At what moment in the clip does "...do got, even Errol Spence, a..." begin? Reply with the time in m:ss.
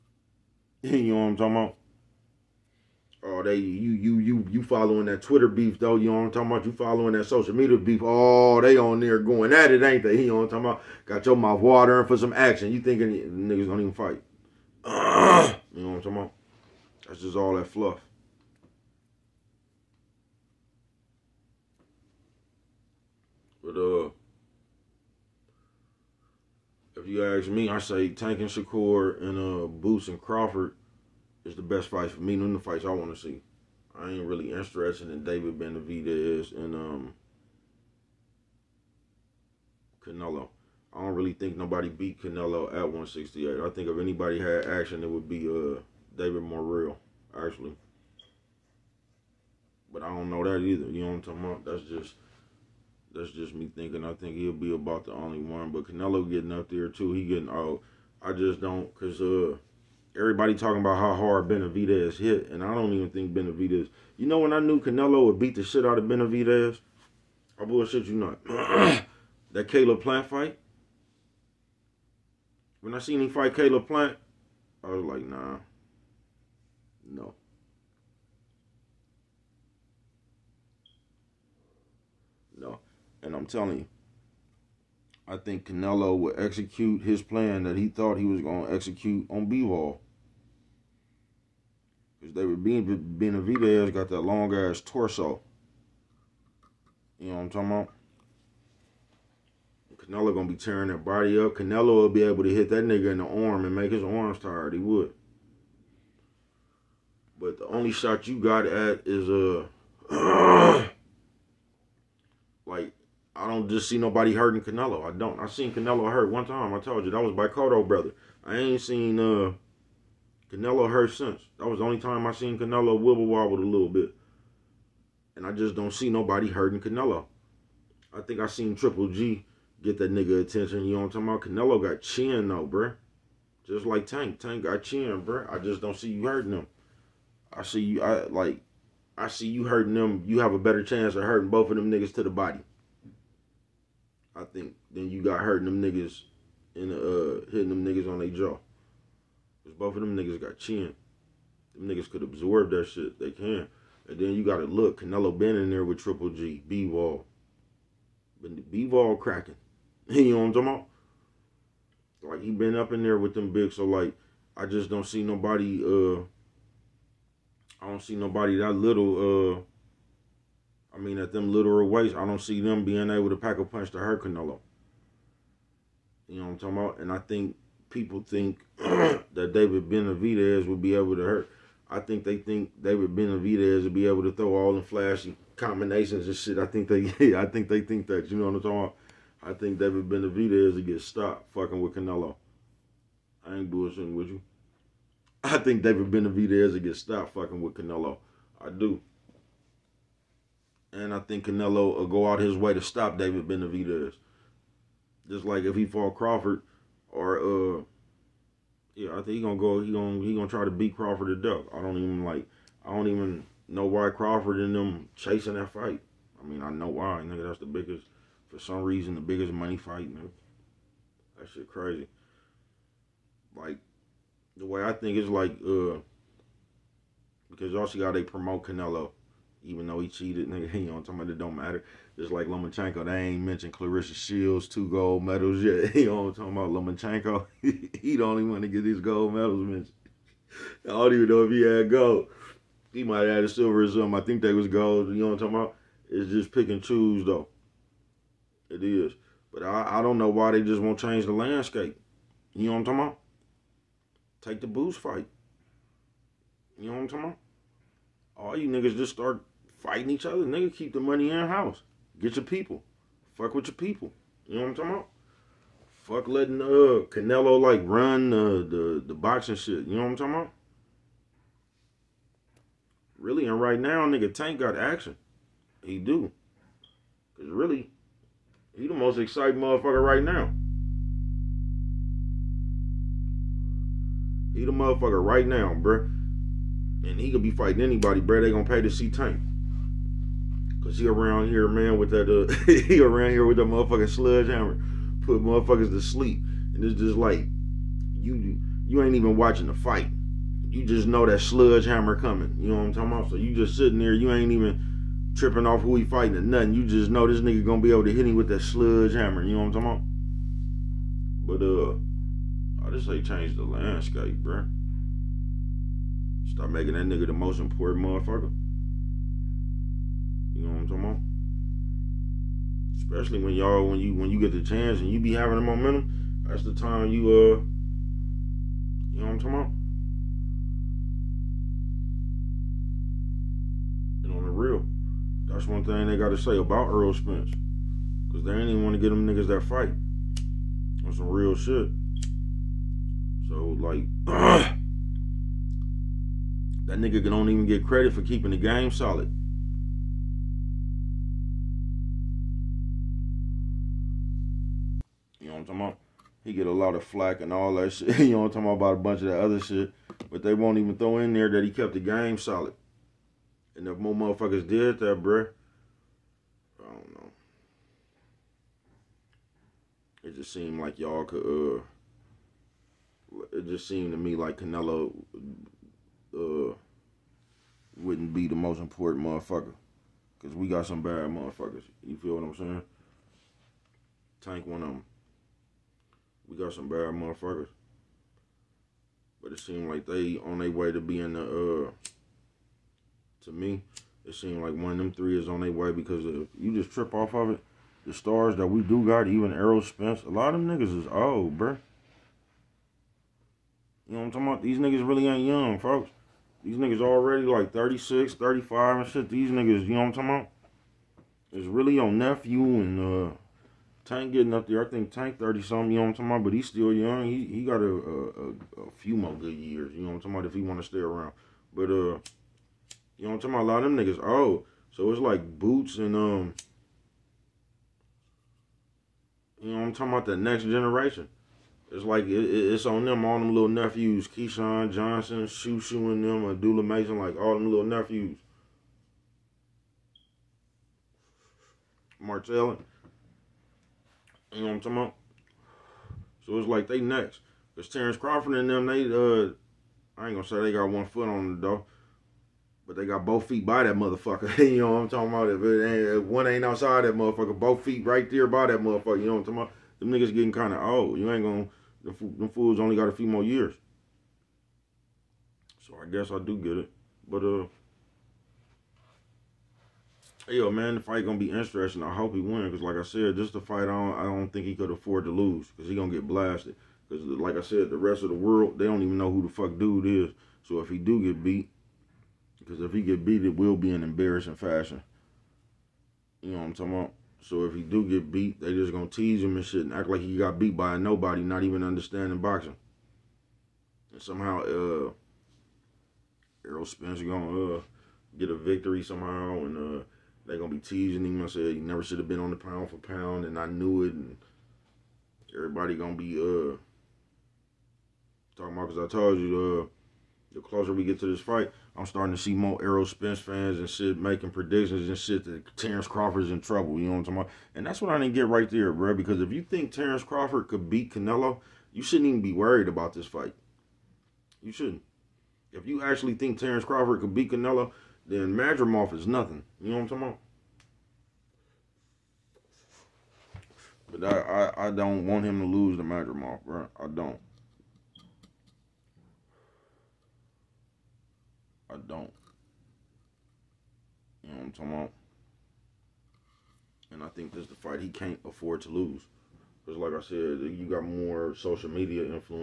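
6:38.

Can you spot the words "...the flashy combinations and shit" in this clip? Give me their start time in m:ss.
3:04.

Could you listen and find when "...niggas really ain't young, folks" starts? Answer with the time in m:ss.
6:44.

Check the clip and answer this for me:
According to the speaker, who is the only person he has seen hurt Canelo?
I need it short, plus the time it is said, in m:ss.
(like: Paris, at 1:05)
Cotto, at 1:57.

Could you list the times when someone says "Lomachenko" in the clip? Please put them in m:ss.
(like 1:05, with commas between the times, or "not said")
3:52, 3:56.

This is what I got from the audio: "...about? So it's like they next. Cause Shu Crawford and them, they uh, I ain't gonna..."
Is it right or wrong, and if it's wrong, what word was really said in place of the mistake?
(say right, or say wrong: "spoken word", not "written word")
wrong: "Terrence", not "Shu".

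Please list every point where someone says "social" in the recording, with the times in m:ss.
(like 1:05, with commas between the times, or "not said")
0:07, 9:11.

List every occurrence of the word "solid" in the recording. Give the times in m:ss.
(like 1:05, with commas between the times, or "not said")
5:48, 6:02.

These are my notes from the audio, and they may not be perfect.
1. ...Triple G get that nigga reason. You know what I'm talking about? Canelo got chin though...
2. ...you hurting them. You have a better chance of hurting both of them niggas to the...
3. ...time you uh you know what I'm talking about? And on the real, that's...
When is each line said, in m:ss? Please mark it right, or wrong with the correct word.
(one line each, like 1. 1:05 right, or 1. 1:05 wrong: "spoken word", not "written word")
1. 2:08 wrong: "attention", not "reason"
2. 2:19 right
3. 5:26 right.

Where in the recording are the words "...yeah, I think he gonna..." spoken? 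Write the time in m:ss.
3:28.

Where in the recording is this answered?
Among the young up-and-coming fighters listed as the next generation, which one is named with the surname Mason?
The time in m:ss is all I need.
7:16.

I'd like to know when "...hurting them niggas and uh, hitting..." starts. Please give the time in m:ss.
2:25.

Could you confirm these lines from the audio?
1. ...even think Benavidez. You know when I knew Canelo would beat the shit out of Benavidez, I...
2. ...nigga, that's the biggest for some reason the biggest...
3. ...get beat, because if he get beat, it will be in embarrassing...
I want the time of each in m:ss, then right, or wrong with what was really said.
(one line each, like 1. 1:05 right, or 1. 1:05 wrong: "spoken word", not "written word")
1. 1:02 right
2. 3:37 right
3. 8:01 right.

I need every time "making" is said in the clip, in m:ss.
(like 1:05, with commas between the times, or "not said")
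5:16, 8:34.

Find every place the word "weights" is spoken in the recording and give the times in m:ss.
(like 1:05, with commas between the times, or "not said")
2:51.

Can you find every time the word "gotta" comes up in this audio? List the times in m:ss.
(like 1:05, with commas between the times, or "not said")
2:34, 5:36.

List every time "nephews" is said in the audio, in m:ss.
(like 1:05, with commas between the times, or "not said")
6:52, 7:13, 7:17.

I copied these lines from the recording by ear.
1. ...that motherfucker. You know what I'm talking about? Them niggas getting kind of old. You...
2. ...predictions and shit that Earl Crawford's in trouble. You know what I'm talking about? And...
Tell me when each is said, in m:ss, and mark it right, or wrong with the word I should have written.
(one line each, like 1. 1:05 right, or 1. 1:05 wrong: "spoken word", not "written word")
1. 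7:38 right
2. 8:34 wrong: "Terrence", not "Earl".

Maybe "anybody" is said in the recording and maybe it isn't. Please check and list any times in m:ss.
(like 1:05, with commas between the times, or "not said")
0:43, 4:47.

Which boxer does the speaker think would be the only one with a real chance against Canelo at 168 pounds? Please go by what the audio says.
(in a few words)
David Morrell.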